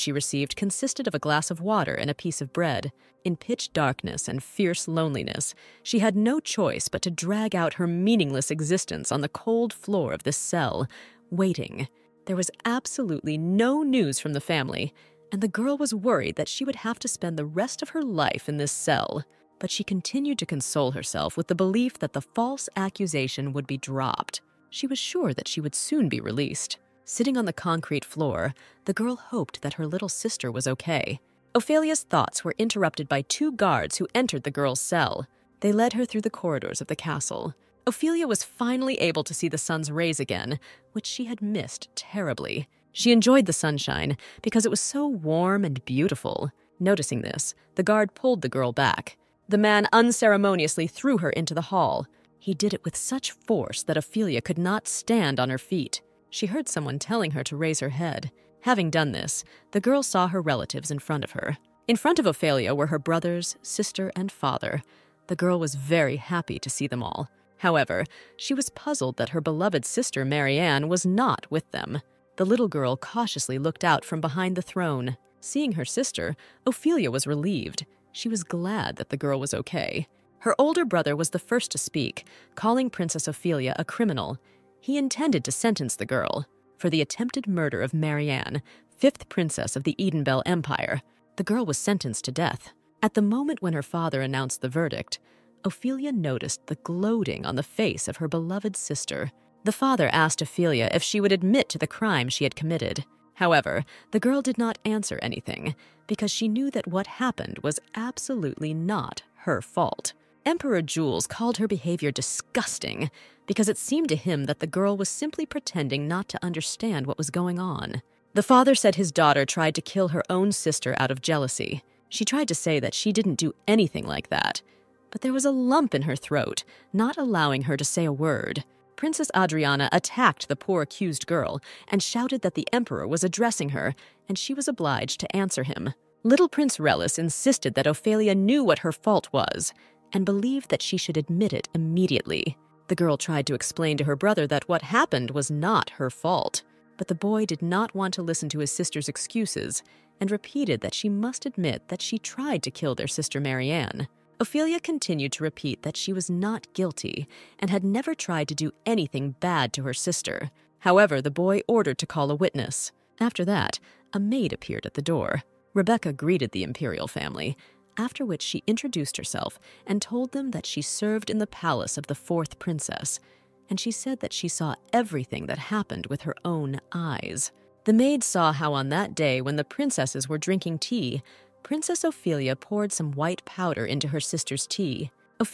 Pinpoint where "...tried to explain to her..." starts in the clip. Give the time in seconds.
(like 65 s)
143 s.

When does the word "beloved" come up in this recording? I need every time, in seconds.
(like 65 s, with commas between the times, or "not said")
69 s, 98 s.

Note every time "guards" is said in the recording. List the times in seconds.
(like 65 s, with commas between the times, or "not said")
33 s, 47 s.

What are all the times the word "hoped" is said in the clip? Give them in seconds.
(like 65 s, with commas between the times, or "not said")
29 s.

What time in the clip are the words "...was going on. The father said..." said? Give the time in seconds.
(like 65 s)
117 s.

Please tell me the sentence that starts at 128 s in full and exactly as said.
Princess Adriana attacked the poor accused girl and shouted that the emperor was addressing her, and she was obliged to answer him.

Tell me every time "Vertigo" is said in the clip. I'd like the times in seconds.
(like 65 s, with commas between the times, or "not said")
not said.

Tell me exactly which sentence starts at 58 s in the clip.
Having done this, the girl saw her relatives in front of her.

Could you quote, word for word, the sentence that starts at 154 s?
Ophelia continued to repeat that she was not guilty and had never tried to do anything bad to her sister.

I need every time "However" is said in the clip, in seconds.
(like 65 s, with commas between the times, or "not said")
67 s, 103 s, 160 s.